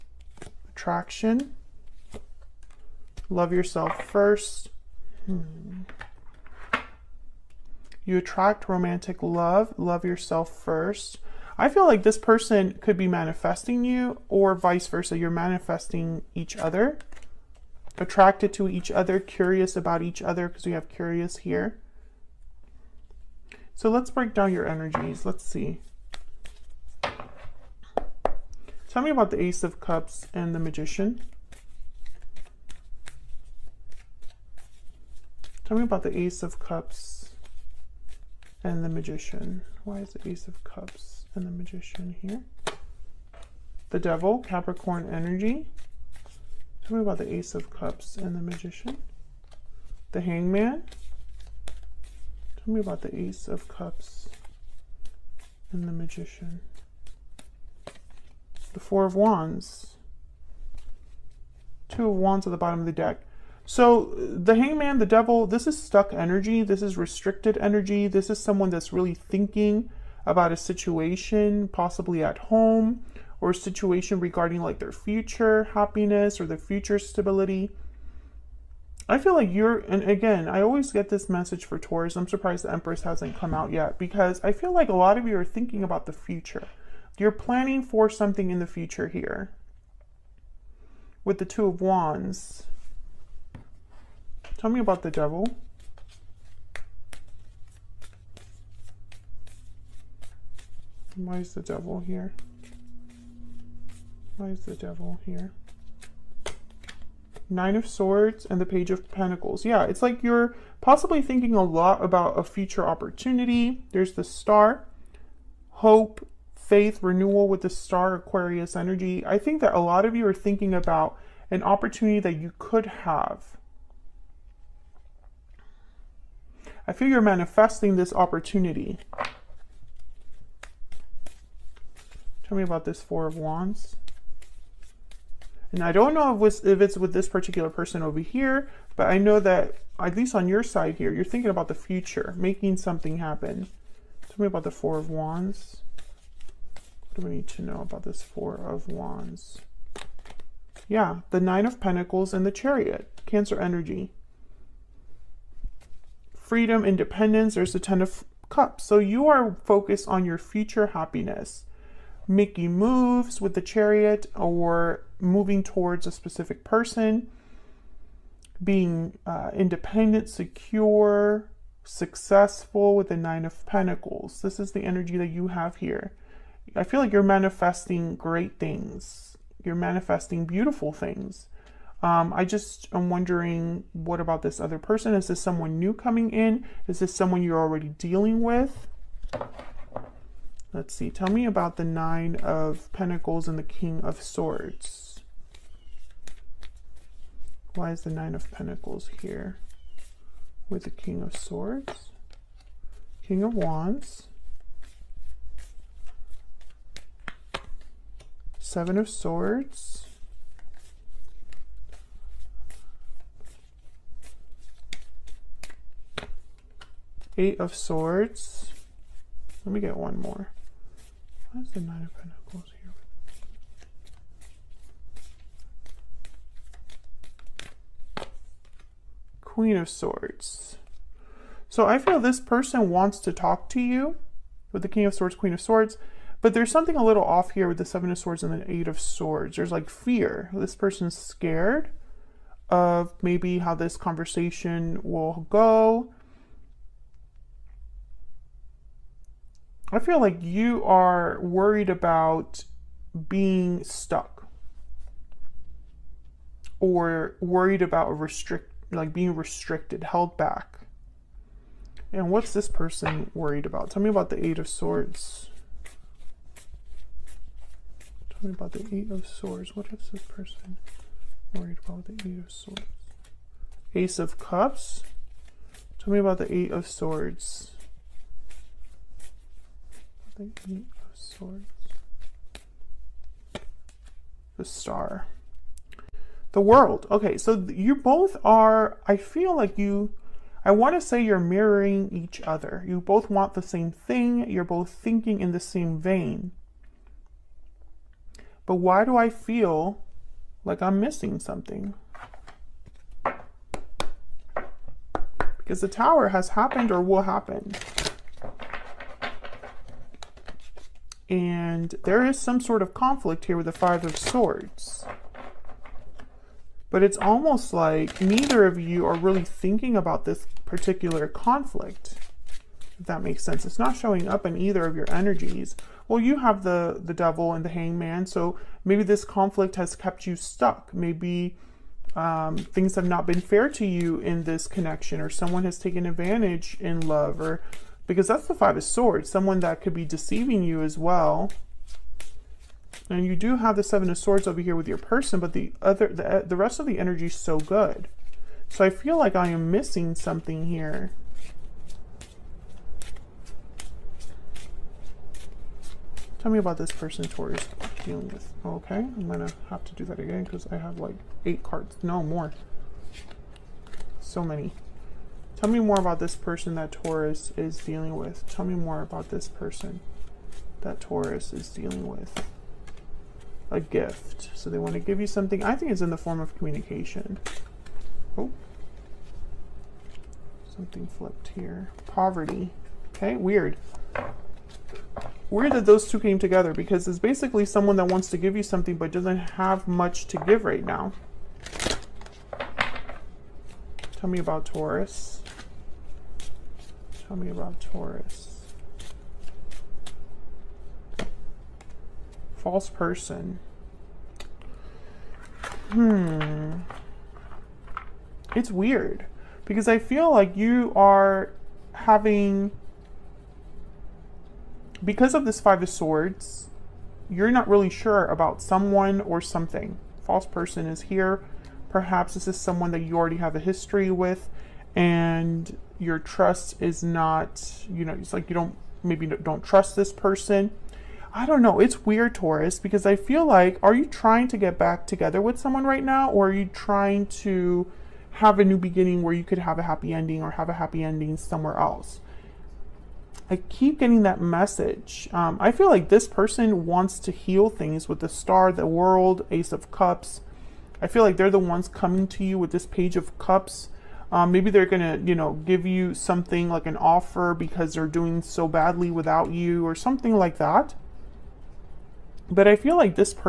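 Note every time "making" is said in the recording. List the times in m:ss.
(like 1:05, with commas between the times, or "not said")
2:22, 2:42.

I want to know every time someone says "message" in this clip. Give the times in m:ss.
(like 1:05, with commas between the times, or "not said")
1:21, 7:24.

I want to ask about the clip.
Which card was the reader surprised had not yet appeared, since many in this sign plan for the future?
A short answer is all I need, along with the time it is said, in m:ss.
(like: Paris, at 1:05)
The Empress, at 1:22.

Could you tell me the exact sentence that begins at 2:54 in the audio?
This is the energy that you have here.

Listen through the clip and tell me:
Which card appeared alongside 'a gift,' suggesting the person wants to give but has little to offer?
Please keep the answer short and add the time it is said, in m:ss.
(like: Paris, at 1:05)
Poverty, at 6:22.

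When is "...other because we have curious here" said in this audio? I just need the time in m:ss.
0:20.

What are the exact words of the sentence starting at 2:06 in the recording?
I feel you're manifesting this opportunity.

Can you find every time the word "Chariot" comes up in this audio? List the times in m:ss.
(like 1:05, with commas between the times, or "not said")
2:32, 2:43.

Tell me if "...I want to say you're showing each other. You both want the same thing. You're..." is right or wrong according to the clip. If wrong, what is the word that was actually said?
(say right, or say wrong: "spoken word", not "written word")
wrong: "mirroring", not "showing".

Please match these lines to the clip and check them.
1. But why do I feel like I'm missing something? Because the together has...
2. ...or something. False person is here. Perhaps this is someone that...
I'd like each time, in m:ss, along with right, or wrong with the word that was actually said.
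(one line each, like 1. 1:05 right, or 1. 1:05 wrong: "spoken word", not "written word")
1. 4:58 wrong: "tower", not "together"
2. 6:59 right.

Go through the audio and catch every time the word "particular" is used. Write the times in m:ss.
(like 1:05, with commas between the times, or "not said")
2:17, 5:20.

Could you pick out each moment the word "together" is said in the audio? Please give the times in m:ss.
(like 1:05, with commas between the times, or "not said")
6:26, 7:15.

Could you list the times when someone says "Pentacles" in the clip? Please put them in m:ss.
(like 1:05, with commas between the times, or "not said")
1:49, 2:31, 2:53, 3:12, 3:18, 3:42.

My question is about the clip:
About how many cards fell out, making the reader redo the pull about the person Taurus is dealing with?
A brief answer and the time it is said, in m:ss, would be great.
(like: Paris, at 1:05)
8, at 6:01.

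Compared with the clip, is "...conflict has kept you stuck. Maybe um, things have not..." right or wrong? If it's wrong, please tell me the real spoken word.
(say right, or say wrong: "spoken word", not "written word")
right.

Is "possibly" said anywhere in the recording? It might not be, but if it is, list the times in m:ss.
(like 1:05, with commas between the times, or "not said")
1:11, 1:50.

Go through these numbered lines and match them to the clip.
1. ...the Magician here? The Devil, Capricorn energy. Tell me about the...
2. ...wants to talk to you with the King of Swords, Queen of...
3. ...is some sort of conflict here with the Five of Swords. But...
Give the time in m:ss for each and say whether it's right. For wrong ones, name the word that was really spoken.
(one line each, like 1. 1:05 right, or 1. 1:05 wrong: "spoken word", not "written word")
1. 0:41 right
2. 3:52 right
3. 5:12 right.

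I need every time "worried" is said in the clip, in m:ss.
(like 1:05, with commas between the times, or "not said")
4:11, 4:17, 4:23, 4:31.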